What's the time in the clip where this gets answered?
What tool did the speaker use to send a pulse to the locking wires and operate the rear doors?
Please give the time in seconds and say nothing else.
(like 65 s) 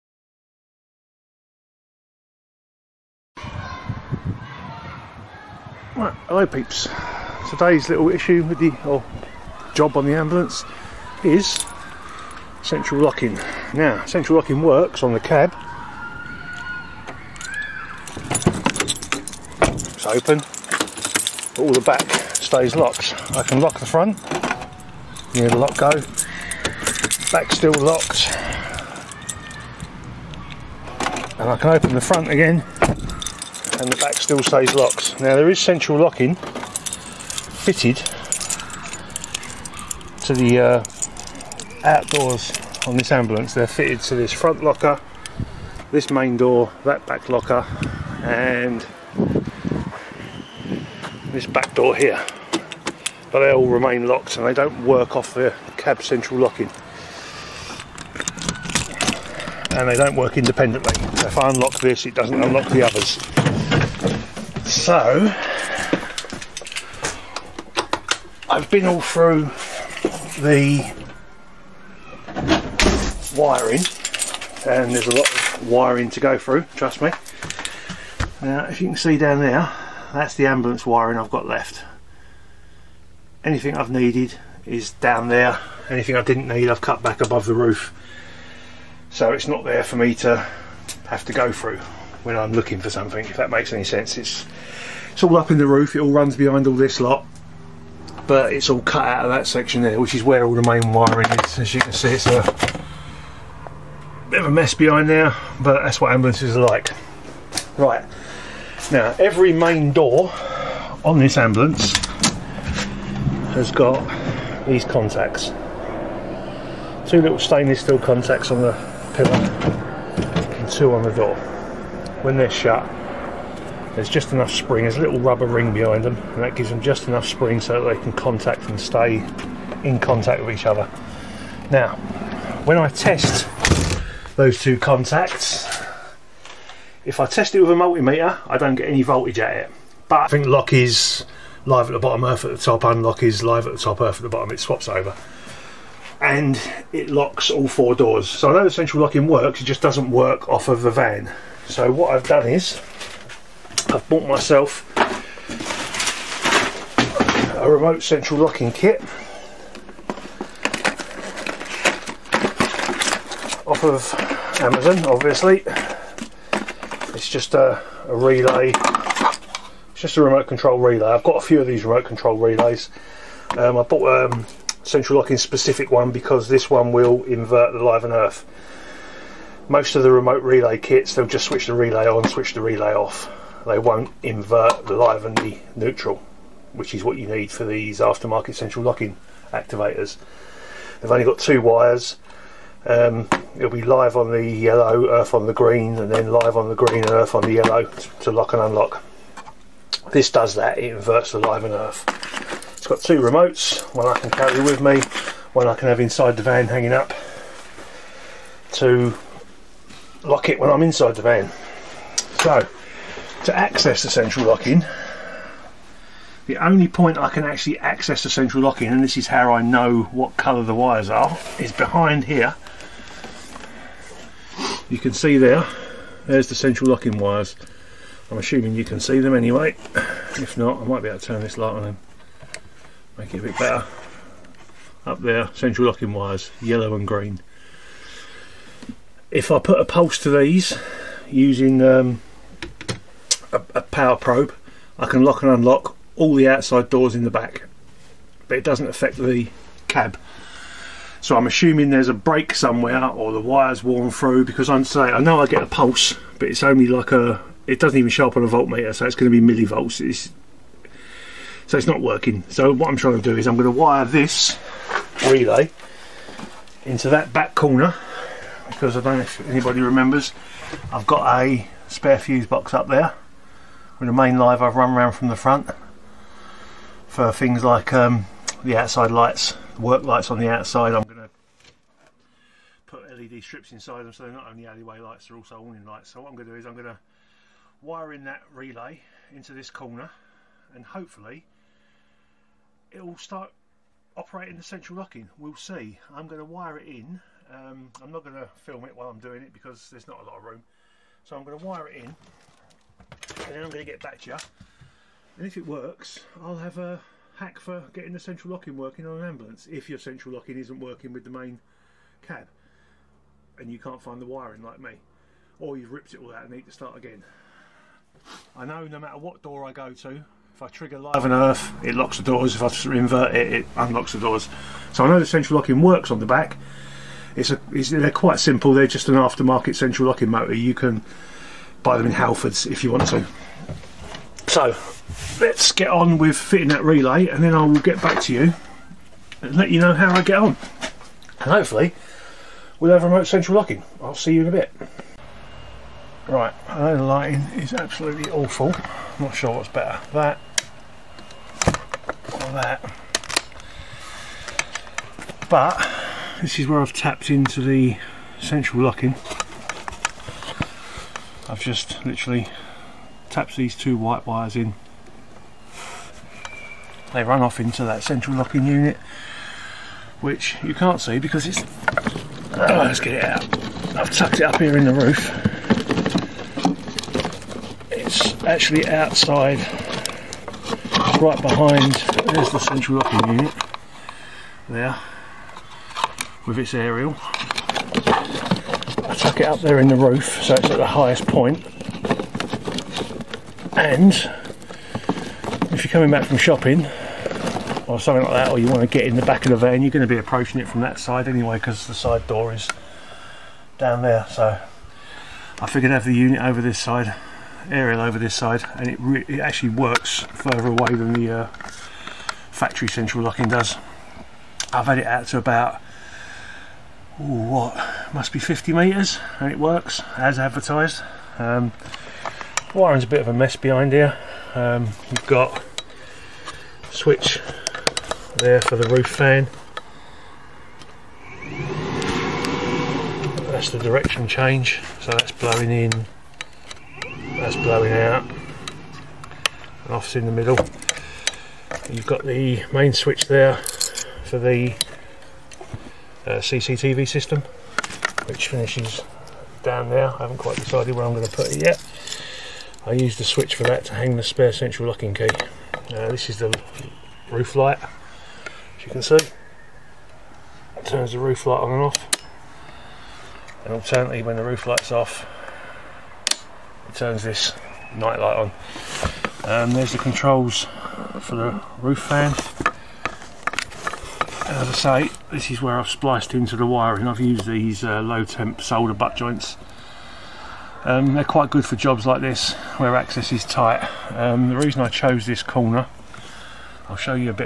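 243 s.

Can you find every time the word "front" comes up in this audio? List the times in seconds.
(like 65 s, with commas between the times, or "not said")
23 s, 32 s, 44 s, 275 s.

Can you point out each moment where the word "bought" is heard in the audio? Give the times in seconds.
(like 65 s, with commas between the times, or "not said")
154 s, 173 s.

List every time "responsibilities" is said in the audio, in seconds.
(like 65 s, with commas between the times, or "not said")
not said.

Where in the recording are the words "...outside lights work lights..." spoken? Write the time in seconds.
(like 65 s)
278 s.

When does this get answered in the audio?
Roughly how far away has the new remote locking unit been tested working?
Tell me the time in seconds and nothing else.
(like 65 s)
418 s.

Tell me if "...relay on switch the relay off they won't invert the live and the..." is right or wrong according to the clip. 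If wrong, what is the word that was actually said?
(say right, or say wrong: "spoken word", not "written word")
right.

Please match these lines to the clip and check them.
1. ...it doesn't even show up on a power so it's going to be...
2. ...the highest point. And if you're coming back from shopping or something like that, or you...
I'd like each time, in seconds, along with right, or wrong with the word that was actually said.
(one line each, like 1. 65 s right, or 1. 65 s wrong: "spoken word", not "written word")
1. 257 s wrong: "voltmeter", not "power"
2. 390 s right.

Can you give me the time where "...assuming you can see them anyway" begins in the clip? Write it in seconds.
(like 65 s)
228 s.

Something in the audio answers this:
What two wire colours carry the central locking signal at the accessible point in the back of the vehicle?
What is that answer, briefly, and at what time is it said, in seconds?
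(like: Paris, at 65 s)
Yellow and green, at 236 s.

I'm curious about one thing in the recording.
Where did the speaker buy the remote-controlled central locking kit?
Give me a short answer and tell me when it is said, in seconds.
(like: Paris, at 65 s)
Amazon, at 164 s.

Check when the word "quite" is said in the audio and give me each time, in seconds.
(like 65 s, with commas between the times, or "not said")
328 s, 450 s, 481 s.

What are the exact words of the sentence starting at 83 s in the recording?
Anything I've needed is down there.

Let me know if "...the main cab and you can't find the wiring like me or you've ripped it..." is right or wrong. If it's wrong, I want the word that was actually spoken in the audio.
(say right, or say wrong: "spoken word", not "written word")
right.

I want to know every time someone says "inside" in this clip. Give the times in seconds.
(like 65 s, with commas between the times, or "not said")
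205 s, 210 s, 283 s.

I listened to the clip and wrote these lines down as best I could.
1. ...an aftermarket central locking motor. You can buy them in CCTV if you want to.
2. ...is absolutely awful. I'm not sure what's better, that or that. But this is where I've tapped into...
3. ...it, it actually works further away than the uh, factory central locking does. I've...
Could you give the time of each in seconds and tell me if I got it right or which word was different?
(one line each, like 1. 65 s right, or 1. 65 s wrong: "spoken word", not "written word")
1. 329 s wrong: "Halfords", not "CCTV"
2. 347 s right
3. 409 s right.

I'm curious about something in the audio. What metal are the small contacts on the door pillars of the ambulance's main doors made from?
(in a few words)
Stainless steel.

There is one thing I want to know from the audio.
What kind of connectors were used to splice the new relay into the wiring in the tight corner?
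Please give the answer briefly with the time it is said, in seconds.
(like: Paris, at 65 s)
Low temp solder butt joints, at 478 s.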